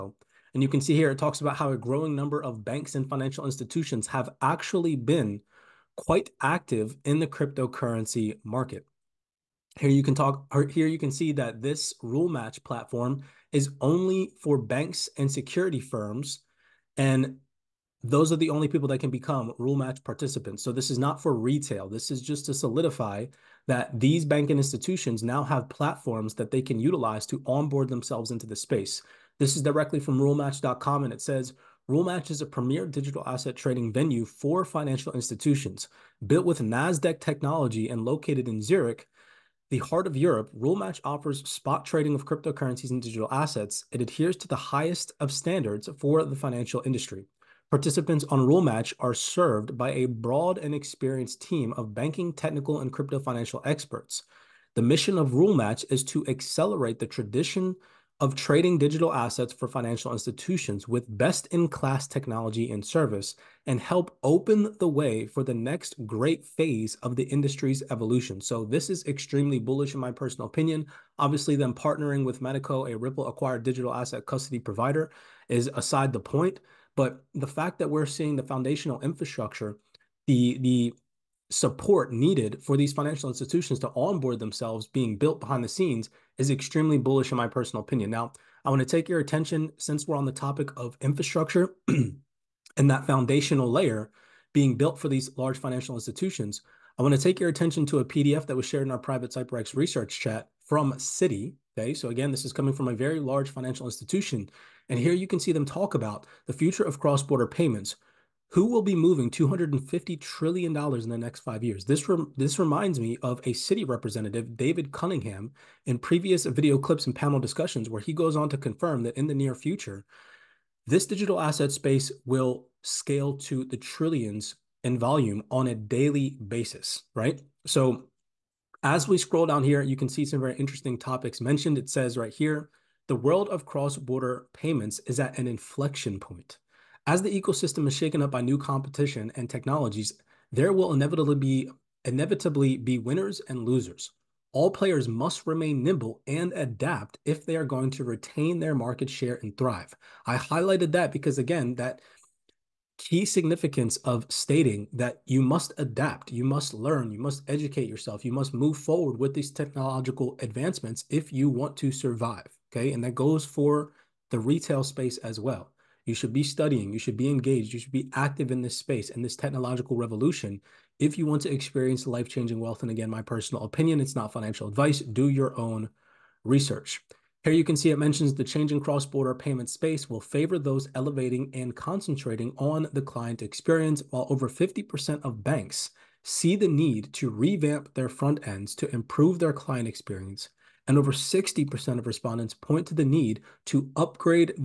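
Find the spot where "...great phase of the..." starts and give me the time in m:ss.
1:06.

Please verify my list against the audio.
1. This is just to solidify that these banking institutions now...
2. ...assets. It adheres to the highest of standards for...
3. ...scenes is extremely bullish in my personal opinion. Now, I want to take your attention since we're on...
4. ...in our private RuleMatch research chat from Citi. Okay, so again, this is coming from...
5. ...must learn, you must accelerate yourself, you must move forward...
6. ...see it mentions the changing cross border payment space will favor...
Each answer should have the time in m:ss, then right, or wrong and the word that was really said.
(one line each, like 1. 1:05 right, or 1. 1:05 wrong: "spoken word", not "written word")
1. 0:21 right
2. 0:43 right
3. 1:25 right
4. 1:38 wrong: "CyberX", not "RuleMatch"
5. 2:36 wrong: "educate", not "accelerate"
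6. 2:57 right.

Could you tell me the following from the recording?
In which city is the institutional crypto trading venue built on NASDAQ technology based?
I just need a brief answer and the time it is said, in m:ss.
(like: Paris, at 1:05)
Zurich, at 0:38.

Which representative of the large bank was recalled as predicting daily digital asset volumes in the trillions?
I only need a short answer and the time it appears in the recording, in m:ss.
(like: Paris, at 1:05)
David Cunningham, at 1:54.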